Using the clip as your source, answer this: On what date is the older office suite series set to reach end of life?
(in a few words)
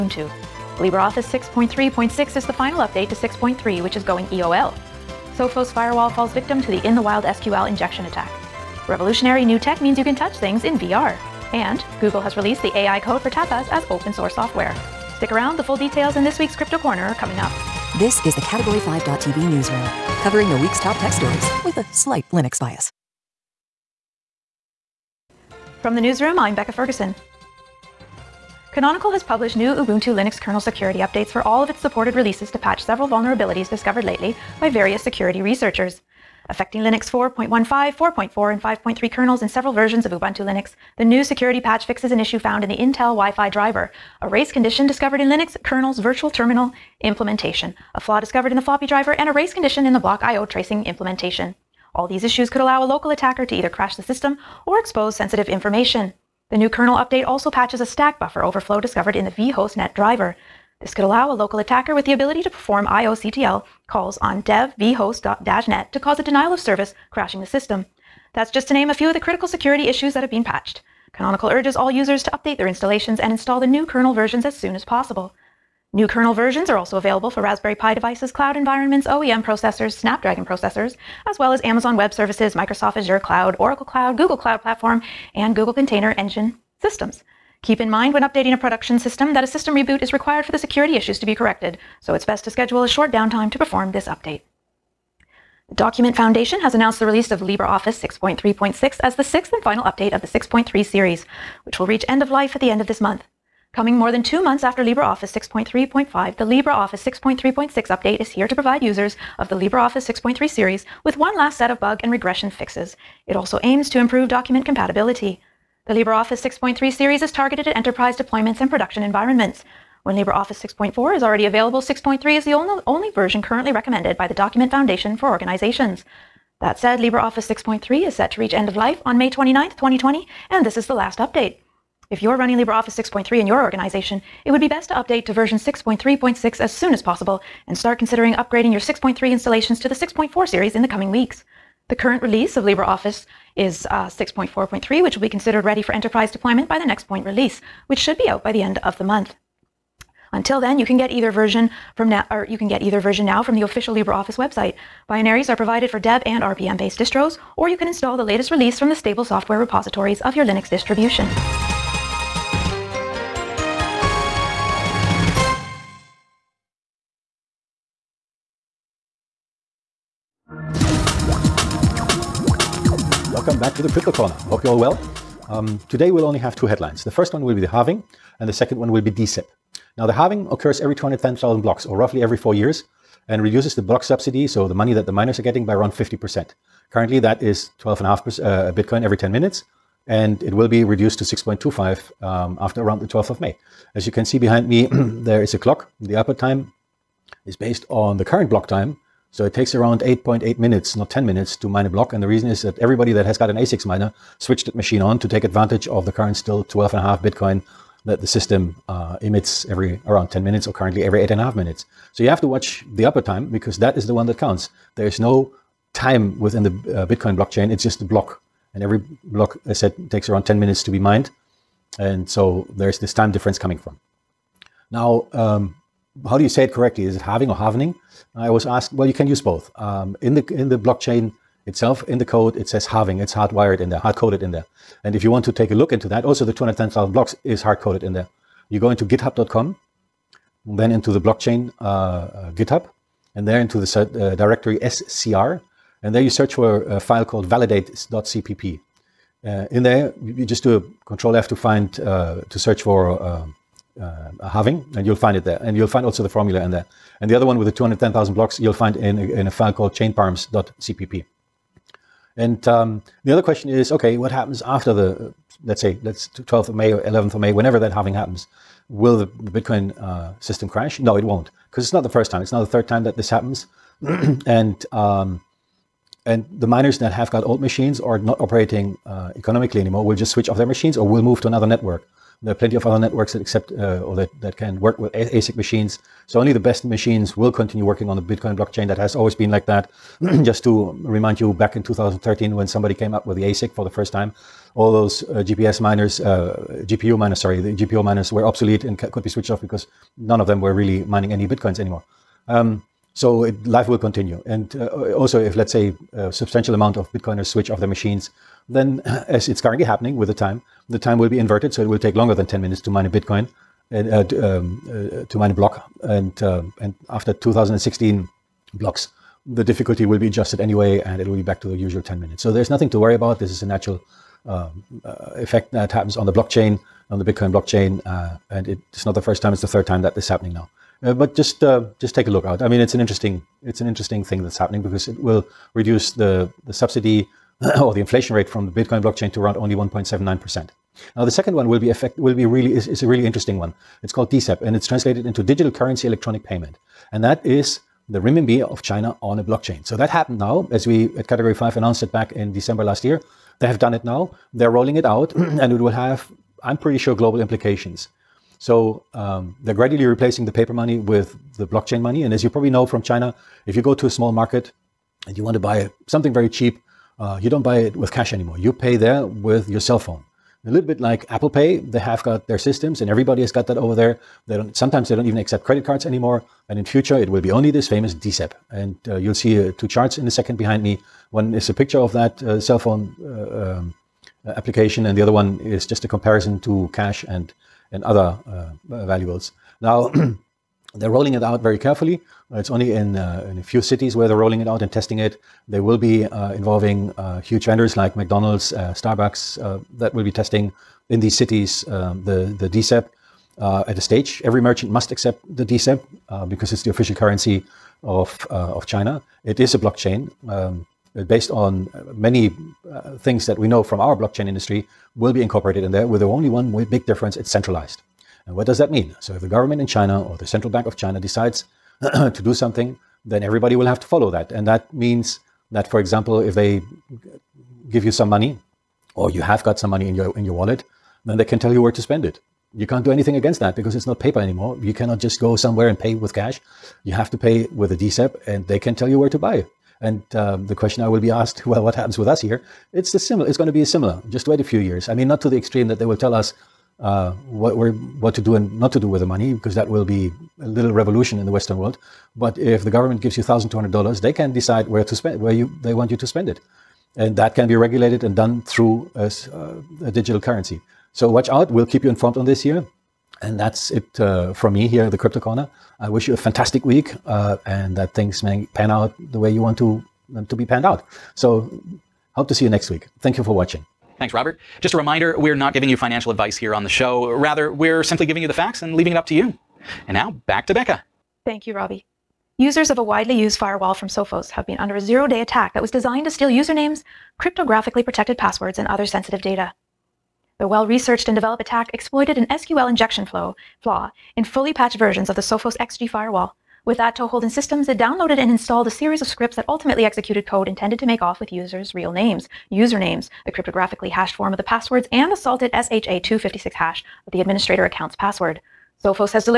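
May 29, 2020.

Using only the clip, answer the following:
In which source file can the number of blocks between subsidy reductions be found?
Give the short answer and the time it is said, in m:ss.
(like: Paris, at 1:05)
chainparams.cpp, at 4:19.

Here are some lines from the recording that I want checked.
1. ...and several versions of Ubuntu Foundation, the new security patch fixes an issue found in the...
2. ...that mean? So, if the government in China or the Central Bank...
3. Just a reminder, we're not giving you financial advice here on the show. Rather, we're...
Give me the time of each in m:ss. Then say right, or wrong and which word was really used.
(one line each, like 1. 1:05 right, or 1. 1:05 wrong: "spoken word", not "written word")
1. 0:39 wrong: "Linux", not "Foundation"
2. 6:58 right
3. 7:54 right.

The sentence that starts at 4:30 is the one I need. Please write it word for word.
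No, it won't, because it's not the first time.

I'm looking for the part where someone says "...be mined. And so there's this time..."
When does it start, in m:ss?
3:40.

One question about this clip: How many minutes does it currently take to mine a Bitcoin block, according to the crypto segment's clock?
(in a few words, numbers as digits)
8.8 minutes.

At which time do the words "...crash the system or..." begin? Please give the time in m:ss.
0:53.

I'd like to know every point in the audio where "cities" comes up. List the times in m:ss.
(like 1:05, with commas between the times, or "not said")
6:33, 6:41.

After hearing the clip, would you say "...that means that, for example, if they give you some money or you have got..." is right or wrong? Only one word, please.
right.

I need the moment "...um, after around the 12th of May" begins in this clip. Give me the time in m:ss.
3:12.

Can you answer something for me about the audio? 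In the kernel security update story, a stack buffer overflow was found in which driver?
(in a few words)
vhost-net driver.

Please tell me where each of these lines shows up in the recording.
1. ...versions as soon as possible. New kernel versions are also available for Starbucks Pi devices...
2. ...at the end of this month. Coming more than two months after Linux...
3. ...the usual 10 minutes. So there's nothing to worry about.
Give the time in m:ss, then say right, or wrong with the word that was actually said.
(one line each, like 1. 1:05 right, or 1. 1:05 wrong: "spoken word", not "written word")
1. 1:14 wrong: "Raspberry", not "Starbucks"
2. 1:42 wrong: "LibreOffice", not "Linux"
3. 5:21 right.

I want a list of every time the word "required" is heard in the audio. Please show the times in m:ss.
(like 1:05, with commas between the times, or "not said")
1:30.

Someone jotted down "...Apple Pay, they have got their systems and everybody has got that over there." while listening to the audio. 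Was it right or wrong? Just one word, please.
right.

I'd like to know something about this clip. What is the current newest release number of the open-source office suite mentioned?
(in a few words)
6.4.3.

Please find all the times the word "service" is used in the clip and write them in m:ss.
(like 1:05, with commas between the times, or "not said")
1:06, 1:22.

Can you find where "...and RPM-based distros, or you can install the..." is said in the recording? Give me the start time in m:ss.
2:36.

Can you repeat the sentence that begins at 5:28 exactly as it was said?
Uh, and it's not the first time, it's the third time that this is happening now.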